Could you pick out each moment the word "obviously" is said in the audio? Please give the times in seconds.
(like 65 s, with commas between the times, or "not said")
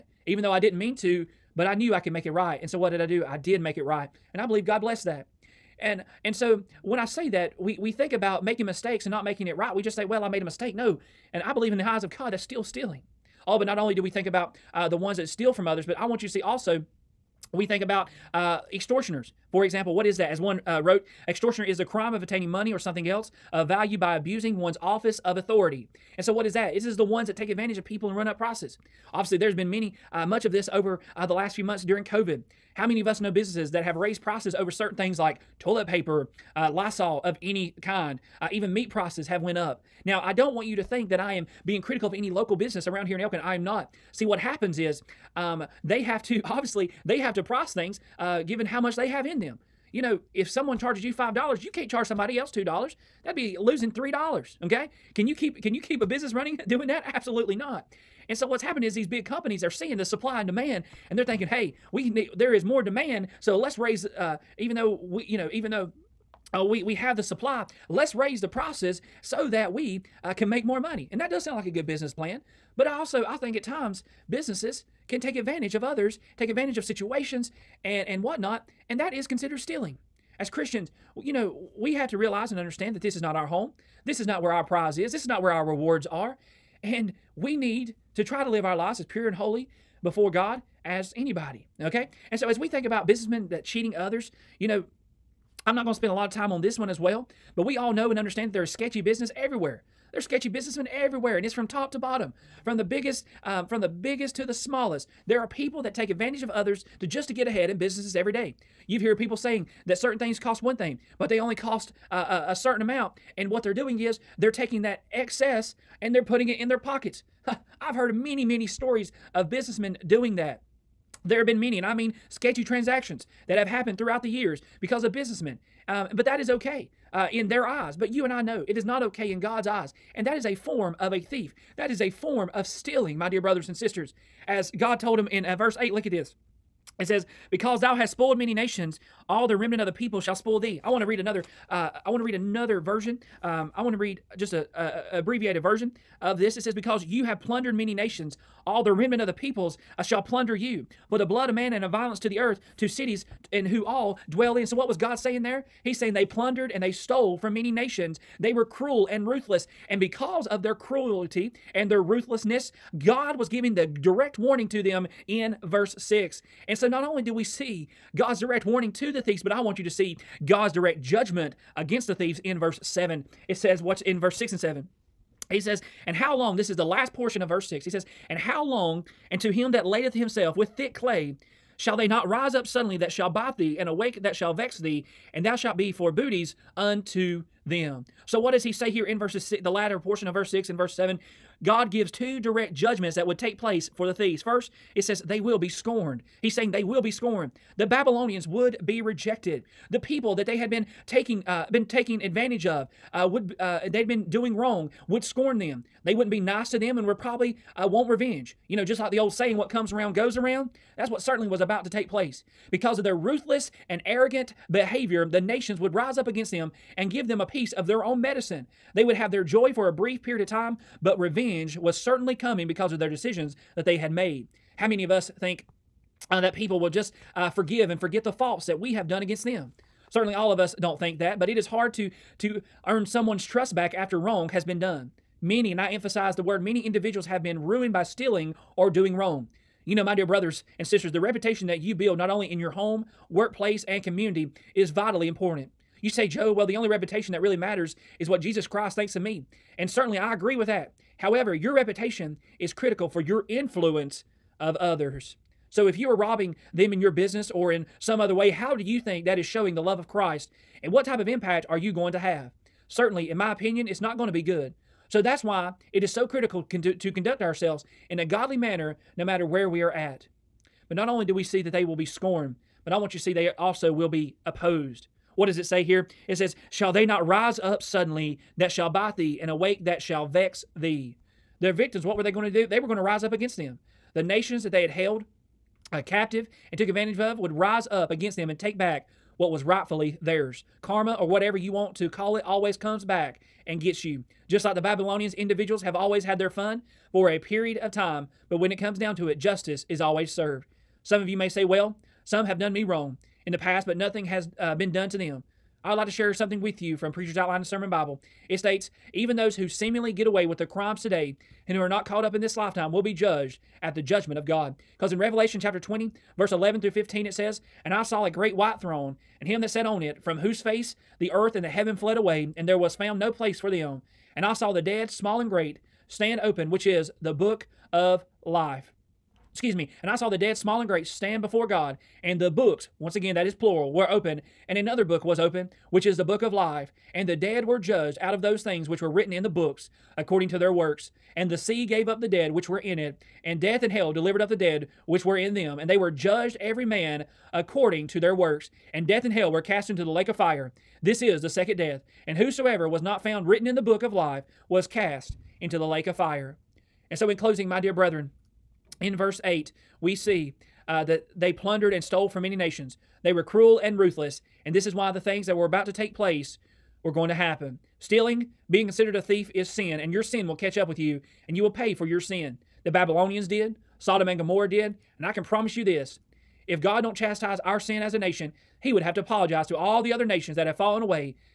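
29 s, 46 s.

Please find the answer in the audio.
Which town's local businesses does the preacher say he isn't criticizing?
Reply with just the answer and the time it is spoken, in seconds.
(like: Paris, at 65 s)
Elkin, at 43 s.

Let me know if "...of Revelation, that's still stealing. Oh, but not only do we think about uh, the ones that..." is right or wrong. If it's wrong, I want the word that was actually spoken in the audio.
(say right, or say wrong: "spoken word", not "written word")
wrong: "God", not "Revelation".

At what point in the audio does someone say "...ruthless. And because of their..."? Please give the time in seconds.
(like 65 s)
159 s.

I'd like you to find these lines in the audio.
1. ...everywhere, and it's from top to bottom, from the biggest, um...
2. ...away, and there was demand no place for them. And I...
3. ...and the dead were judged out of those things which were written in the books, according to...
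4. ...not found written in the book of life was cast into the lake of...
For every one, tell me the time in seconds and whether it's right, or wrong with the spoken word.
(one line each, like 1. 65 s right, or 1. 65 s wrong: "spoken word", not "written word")
1. 100 s right
2. 322 s wrong: "found", not "demand"
3. 337 s right
4. 353 s right.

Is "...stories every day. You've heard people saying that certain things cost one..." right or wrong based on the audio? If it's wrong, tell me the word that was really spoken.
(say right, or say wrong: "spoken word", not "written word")
wrong: "businesses", not "stories".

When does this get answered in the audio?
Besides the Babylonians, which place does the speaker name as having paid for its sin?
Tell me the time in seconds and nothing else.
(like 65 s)
373 s.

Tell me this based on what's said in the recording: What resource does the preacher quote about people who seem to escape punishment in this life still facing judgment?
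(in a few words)
Preacher's Outline and Sermon Bible.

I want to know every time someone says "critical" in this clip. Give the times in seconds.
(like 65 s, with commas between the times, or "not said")
41 s, 252 s, 266 s.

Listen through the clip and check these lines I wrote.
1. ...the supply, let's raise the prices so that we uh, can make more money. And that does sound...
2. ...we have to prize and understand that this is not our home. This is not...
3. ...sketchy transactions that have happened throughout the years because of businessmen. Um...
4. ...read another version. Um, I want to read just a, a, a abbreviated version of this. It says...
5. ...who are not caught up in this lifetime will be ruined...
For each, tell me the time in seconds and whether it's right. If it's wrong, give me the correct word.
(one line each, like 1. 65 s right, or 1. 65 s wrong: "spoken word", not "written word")
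1. 67 s right
2. 81 s wrong: "realize", not "prize"
3. 122 s right
4. 142 s right
5. 311 s wrong: "judged", not "ruined".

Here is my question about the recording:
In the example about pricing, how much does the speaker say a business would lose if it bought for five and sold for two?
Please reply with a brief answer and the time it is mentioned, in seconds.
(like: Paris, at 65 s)
3 dollars, at 53 s.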